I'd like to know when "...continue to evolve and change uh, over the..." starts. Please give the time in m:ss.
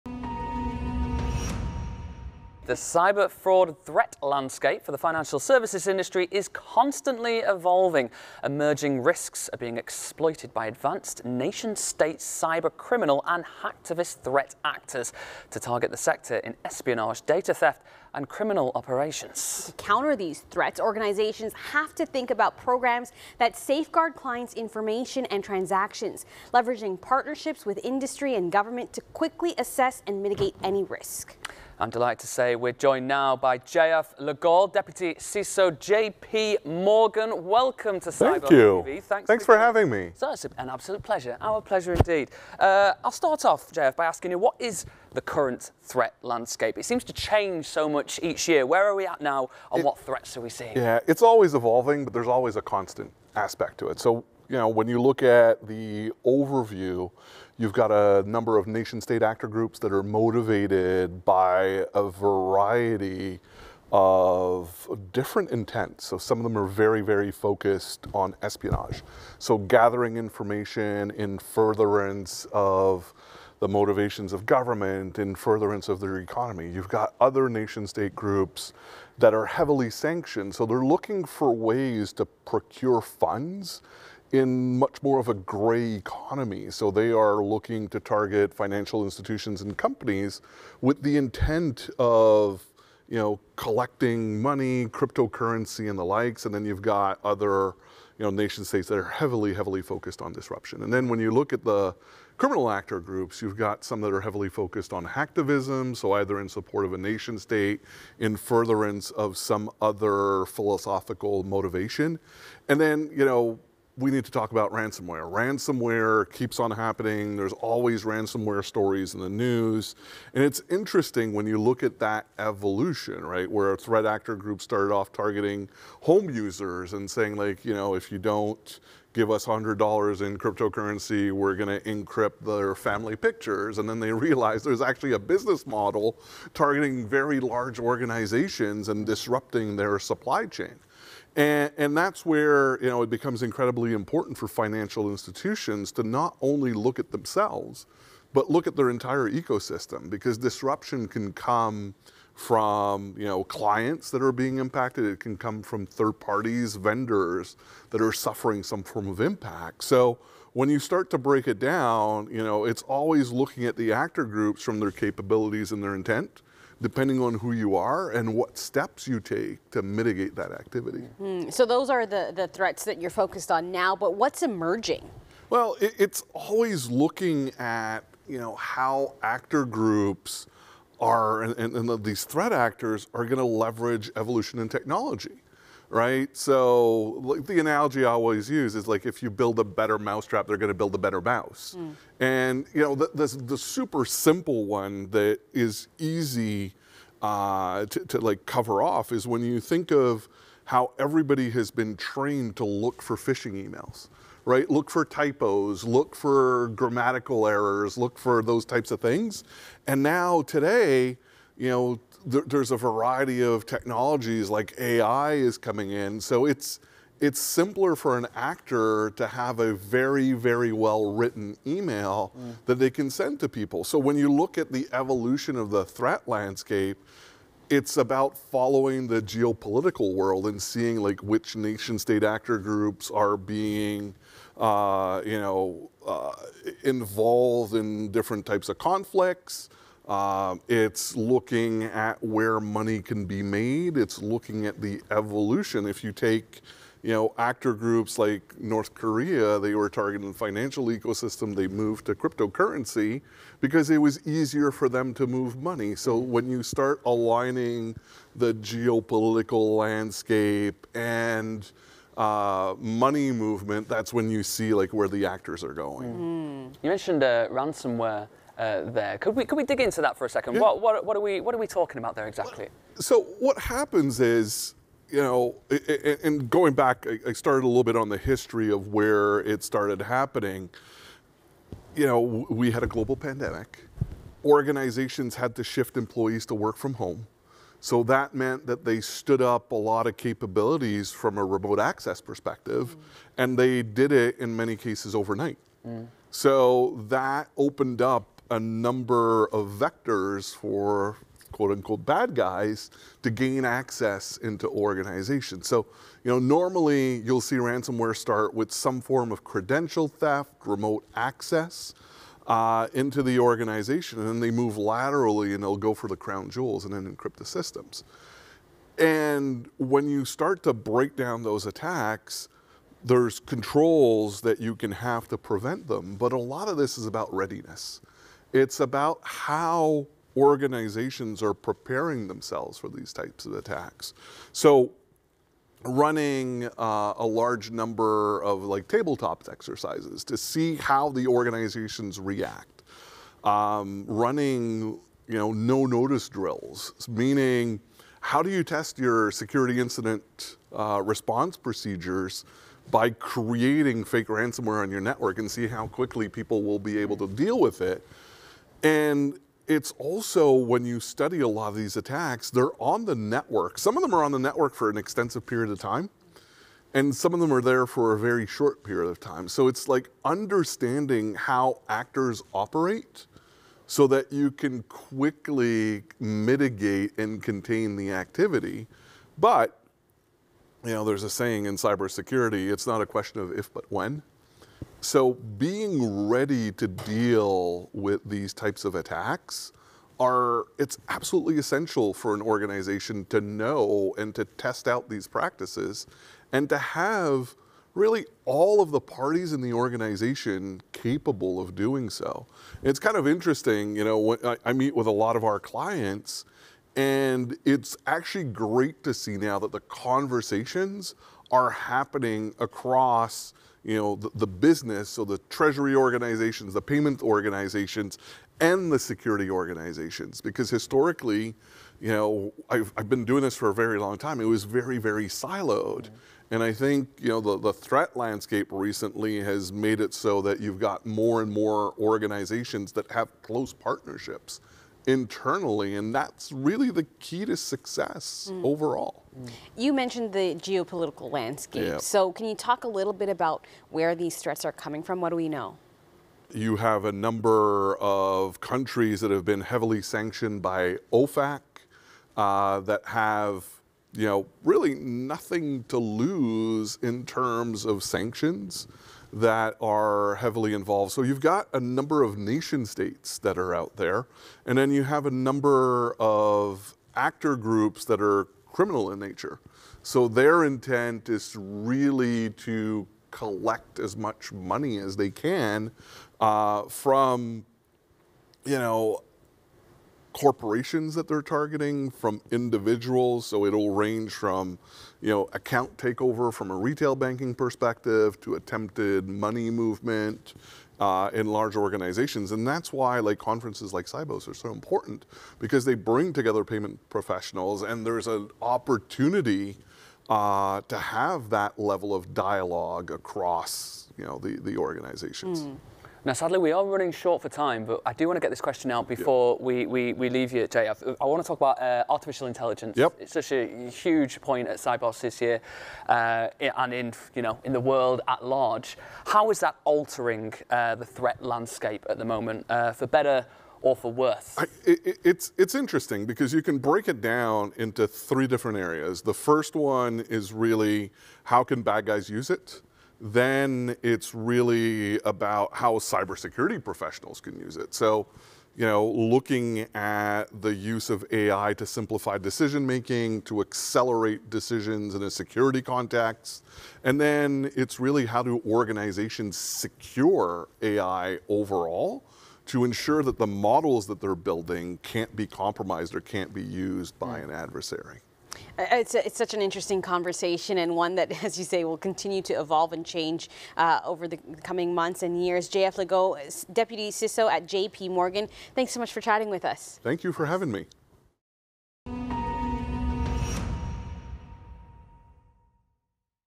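9:21.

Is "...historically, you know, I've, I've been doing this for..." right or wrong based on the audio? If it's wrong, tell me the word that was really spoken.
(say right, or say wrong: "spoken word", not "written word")
right.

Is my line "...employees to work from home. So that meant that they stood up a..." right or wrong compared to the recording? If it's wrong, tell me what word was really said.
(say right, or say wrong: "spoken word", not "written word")
right.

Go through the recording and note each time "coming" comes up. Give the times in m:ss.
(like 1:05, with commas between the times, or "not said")
3:35, 7:24, 9:24.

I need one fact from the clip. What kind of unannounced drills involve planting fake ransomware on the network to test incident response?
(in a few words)
No notice drills.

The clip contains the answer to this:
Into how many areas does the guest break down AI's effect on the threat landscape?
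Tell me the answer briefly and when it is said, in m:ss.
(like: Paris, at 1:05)
3, at 8:48.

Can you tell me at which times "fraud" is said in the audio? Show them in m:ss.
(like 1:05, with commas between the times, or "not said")
0:03.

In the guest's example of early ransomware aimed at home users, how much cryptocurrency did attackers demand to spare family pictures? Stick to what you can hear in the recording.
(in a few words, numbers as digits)
$100.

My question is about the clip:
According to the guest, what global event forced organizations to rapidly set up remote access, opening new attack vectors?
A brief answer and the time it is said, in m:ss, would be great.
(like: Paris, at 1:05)
A global pandemic, at 4:42.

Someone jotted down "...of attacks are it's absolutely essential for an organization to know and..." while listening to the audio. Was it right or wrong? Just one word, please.
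right.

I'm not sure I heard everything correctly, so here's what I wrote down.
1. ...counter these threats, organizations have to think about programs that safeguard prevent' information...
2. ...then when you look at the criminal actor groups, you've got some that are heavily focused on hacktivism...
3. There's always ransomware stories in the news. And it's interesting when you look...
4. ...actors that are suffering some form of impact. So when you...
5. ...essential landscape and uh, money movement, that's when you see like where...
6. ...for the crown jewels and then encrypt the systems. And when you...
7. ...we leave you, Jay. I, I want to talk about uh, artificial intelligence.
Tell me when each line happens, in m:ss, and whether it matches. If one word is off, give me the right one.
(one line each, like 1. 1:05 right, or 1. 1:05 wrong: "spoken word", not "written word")
1. 0:19 wrong: "clients", not "prevent"
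2. 1:40 right
3. 1:57 right
4. 2:36 wrong: "vendors", not "actors"
5. 4:18 wrong: "geopolitical", not "essential"
6. 5:15 right
7. 8:30 right.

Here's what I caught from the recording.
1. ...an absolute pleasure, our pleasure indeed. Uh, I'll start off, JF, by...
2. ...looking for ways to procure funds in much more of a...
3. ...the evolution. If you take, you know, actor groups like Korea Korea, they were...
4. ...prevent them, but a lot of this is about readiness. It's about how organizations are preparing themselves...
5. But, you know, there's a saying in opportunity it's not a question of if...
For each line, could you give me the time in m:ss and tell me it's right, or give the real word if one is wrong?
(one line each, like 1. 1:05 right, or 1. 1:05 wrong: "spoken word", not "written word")
1. 0:40 right
2. 1:20 right
3. 4:04 wrong: "North", not "Korea"
4. 5:25 right
5. 6:19 wrong: "cybersecurity", not "opportunity".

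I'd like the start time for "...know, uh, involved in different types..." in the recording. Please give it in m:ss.
3:55.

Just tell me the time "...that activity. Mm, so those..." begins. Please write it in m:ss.
2:50.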